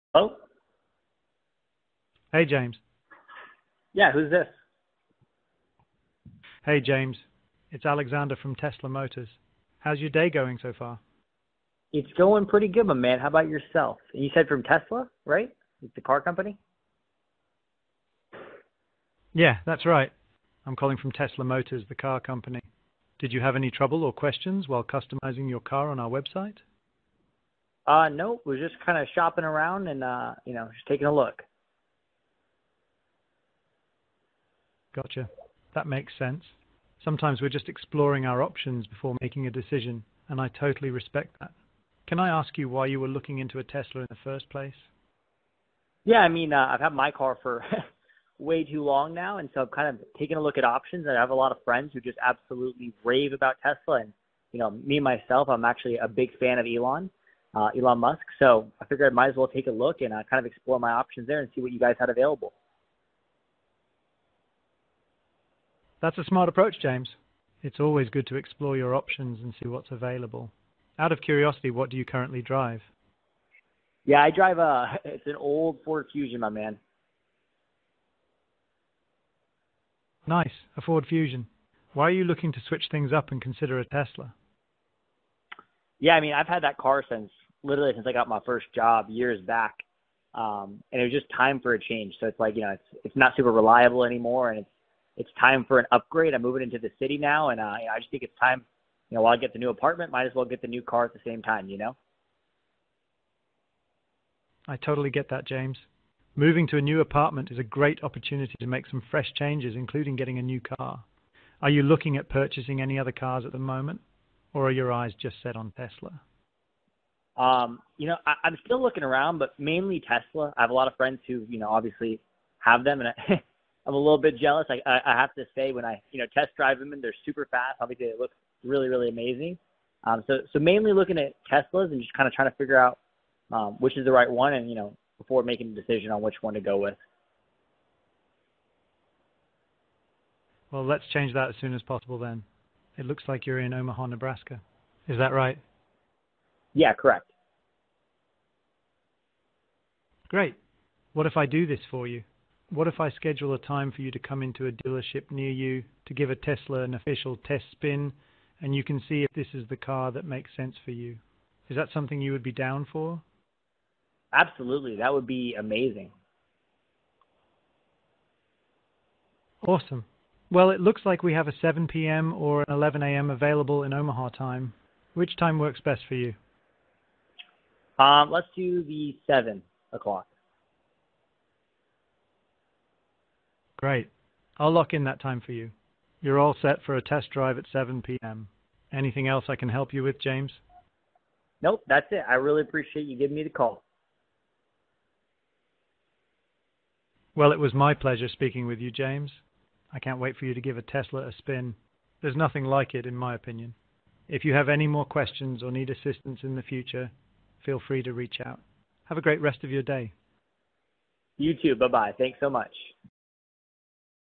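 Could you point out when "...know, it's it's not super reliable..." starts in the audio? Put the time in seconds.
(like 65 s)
92 s.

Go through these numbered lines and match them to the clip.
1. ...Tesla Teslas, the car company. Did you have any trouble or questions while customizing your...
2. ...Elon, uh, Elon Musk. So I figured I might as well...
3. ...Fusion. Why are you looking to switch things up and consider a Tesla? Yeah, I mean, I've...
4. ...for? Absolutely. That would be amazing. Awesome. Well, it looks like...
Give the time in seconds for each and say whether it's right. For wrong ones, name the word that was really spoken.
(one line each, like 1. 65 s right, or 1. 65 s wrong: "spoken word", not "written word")
1. 21 s wrong: "Motors", not "Teslas"
2. 56 s right
3. 81 s right
4. 162 s right.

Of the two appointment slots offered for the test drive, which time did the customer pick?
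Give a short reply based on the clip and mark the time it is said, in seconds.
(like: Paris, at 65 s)
7 p.m., at 179 s.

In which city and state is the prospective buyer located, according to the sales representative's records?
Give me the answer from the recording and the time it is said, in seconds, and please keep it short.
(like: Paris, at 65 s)
Omaha, Nebraska, at 143 s.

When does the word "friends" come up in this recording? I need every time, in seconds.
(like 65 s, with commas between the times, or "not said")
51 s, 120 s.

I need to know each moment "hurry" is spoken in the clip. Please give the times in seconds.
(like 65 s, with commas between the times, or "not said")
not said.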